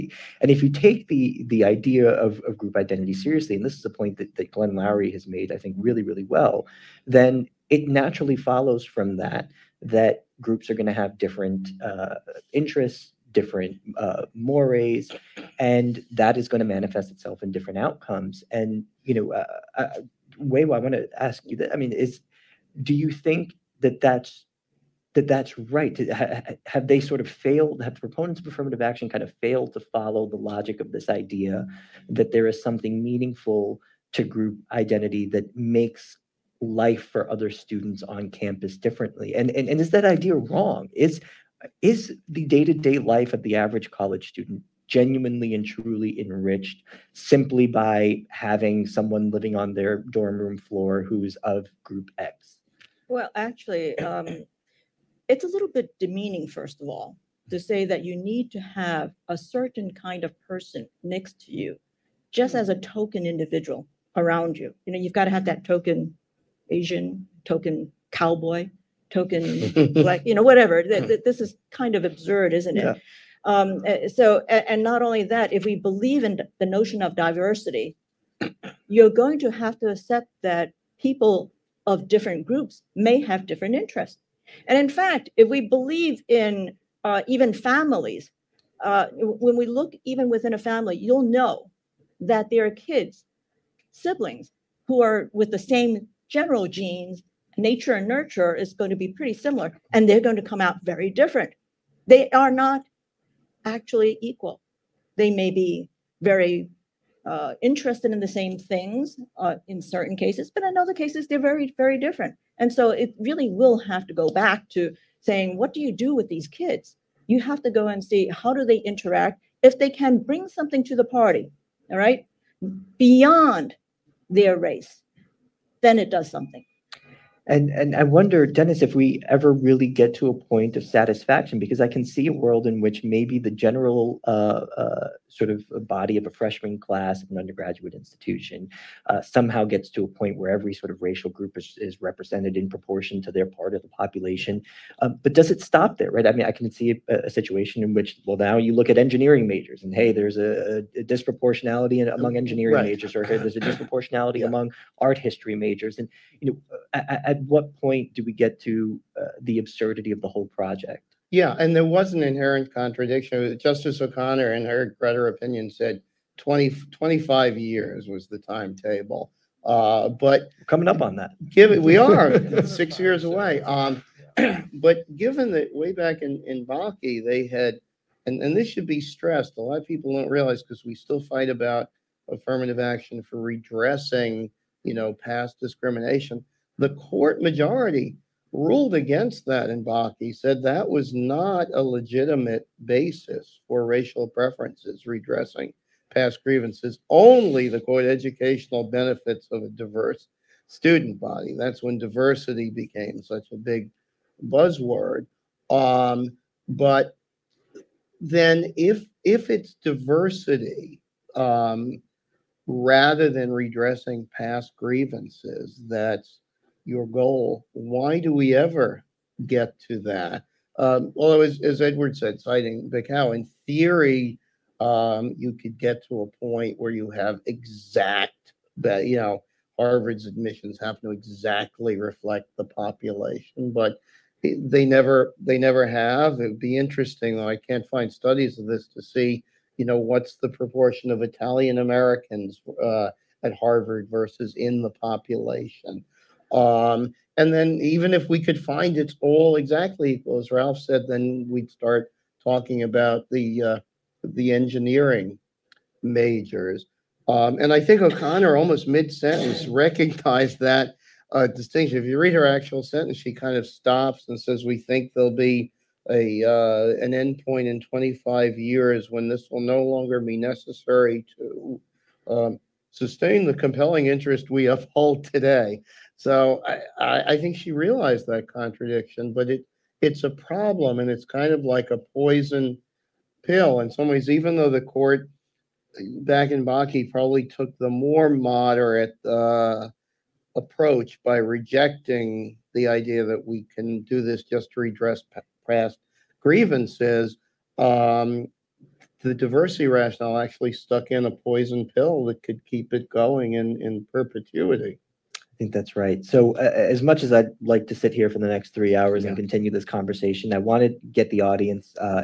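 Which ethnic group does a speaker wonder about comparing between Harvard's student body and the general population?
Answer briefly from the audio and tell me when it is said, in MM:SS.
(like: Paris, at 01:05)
Italian Americans, at 04:01.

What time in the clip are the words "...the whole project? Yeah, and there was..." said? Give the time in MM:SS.
02:40.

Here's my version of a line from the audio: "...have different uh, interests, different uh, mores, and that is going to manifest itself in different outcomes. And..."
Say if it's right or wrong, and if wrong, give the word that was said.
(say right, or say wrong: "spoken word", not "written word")
right.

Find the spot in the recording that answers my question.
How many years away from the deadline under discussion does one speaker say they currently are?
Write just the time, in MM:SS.
02:52.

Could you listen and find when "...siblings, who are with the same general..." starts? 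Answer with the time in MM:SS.
01:34.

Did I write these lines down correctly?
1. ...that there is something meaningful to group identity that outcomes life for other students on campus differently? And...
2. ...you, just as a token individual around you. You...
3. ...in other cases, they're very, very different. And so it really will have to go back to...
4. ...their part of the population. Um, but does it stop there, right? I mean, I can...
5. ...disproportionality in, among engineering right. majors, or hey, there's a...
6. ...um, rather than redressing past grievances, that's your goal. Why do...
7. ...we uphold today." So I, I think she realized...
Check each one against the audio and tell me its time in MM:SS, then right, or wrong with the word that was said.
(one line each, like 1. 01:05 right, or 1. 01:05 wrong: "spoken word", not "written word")
1. 00:32 wrong: "makes", not "outcomes"
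2. 01:01 right
3. 01:50 right
4. 02:23 right
5. 02:31 right
6. 03:31 right
7. 04:34 right.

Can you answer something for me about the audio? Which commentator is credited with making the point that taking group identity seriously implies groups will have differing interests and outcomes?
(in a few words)
Glenn Loury.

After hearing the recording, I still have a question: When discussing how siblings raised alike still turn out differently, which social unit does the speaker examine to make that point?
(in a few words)
families.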